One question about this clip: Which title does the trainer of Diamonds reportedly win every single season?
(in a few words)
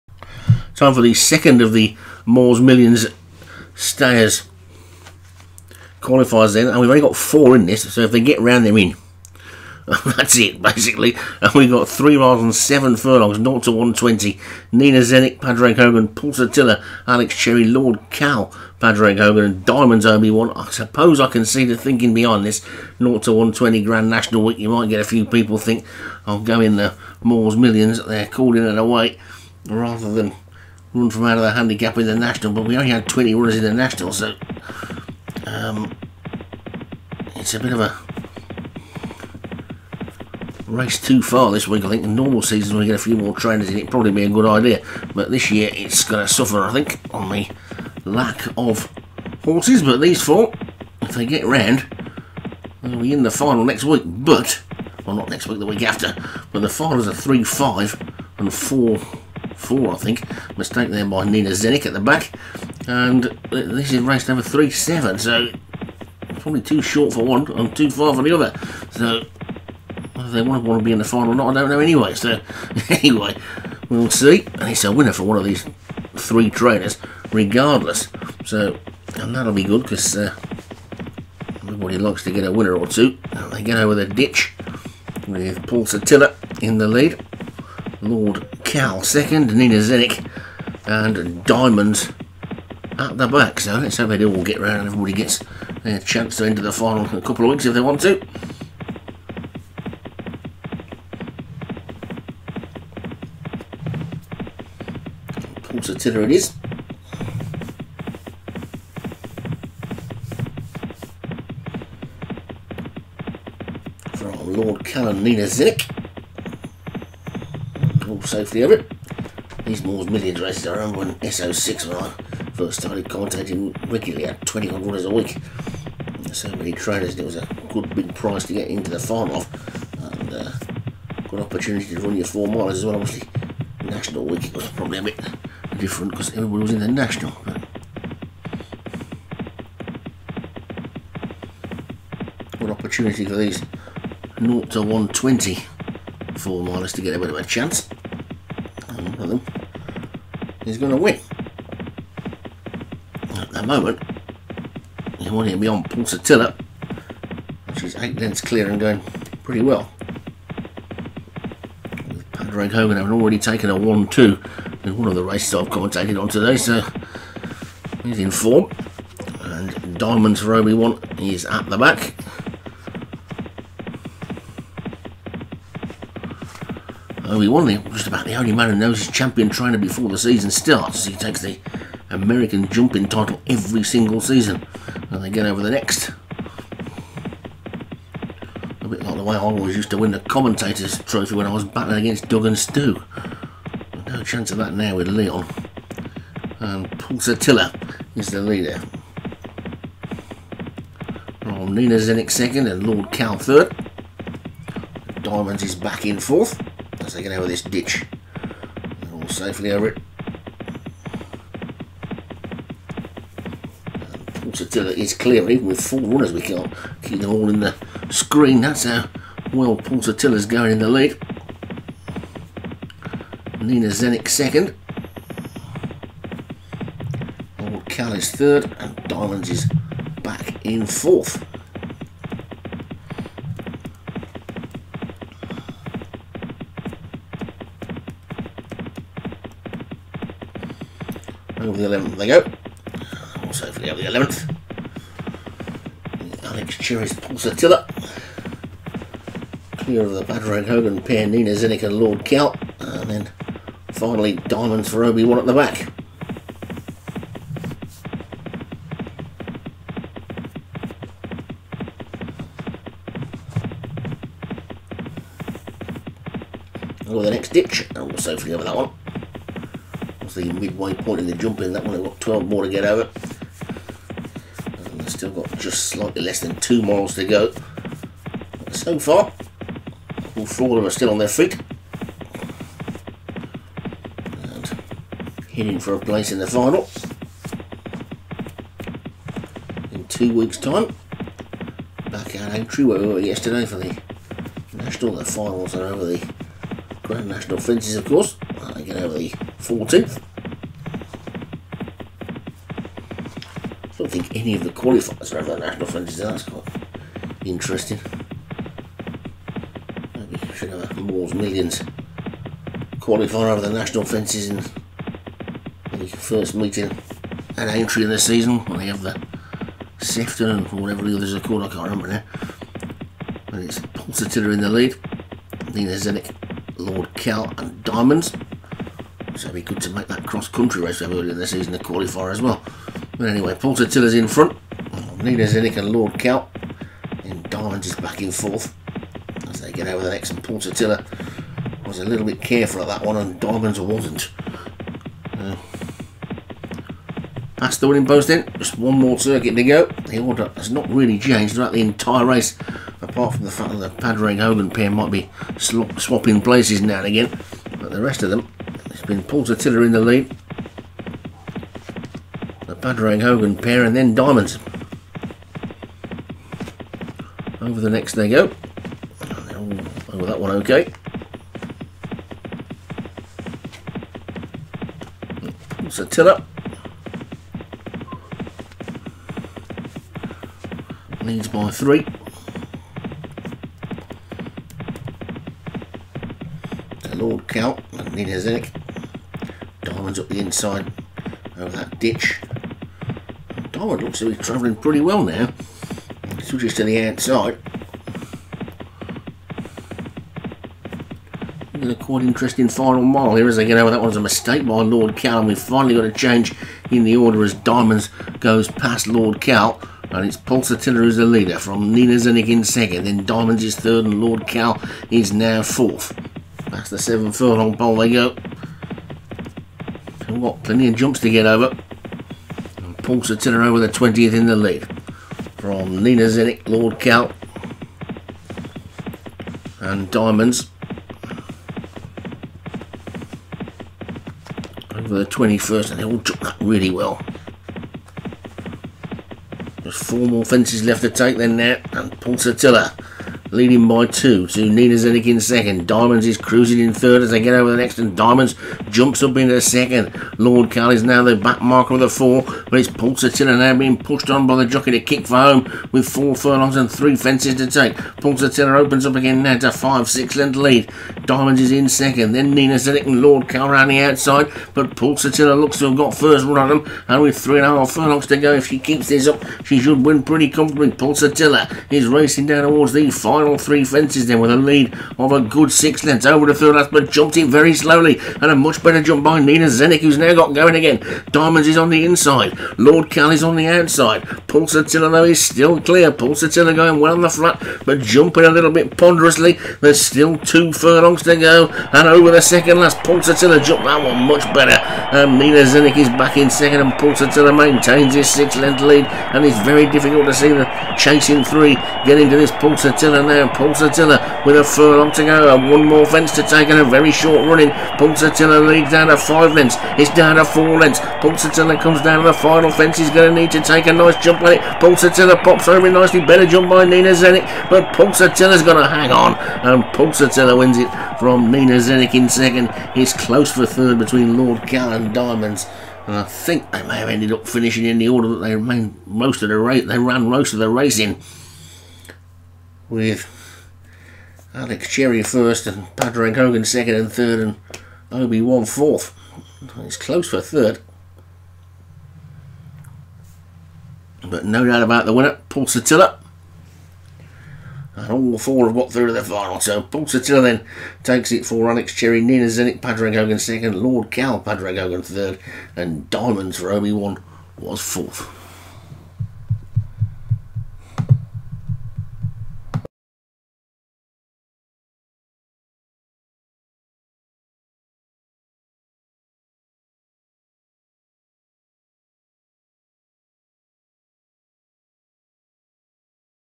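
American jumping title.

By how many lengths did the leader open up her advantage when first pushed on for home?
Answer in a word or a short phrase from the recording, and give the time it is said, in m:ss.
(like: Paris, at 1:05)
5 or 6 lengths, at 7:39.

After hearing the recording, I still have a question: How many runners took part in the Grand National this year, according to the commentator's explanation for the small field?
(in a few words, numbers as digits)
20.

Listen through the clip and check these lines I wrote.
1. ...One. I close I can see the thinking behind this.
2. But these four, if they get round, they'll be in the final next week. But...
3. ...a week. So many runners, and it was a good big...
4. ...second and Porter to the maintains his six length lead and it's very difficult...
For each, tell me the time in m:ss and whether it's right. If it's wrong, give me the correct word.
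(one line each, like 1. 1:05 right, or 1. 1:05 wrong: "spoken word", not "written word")
1. 0:20 wrong: "suppose", not "close"
2. 0:49 right
3. 2:05 wrong: "trainers", not "runners"
4. 8:16 right.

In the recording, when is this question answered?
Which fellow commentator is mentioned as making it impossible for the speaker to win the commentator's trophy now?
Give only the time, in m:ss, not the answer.
3:15.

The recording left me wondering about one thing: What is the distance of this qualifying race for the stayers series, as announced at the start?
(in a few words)
3 miles 7 furlongs.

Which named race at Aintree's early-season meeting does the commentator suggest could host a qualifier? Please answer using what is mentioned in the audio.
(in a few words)
Sefton.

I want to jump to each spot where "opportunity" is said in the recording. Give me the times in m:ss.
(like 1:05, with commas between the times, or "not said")
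2:11, 2:22.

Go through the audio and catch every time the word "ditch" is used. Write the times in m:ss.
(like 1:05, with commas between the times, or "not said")
1:24, 3:27, 4:27, 6:32.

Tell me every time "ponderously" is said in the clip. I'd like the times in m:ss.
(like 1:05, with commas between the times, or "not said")
8:08.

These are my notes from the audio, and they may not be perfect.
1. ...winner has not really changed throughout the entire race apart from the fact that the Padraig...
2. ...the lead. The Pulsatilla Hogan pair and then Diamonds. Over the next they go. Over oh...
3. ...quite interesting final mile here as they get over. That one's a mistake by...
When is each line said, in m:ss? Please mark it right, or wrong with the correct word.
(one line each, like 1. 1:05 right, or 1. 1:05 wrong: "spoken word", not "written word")
1. 5:50 wrong: "order", not "winner"
2. 5:59 wrong: "Padraig", not "Pulsatilla"
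3. 6:41 right.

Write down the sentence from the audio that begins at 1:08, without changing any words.
So whether they want to be in the final or not, I don't know anyway.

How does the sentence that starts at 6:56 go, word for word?
That's the seven furlong pole they go.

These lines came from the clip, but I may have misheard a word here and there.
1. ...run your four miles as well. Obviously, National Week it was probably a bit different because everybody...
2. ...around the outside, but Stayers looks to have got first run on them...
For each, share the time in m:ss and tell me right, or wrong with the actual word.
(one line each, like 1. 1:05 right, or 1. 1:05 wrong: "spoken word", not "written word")
1. 2:12 right
2. 7:43 wrong: "Pulsatilla", not "Stayers".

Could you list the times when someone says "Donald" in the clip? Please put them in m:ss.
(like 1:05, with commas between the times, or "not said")
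not said.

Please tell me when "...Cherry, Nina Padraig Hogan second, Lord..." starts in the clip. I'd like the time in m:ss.
9:11.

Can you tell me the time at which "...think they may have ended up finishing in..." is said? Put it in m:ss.
8:46.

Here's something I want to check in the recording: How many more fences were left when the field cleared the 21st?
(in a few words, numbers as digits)
4.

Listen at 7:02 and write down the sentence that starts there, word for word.
And Pulsatilla with the 20th in the lead.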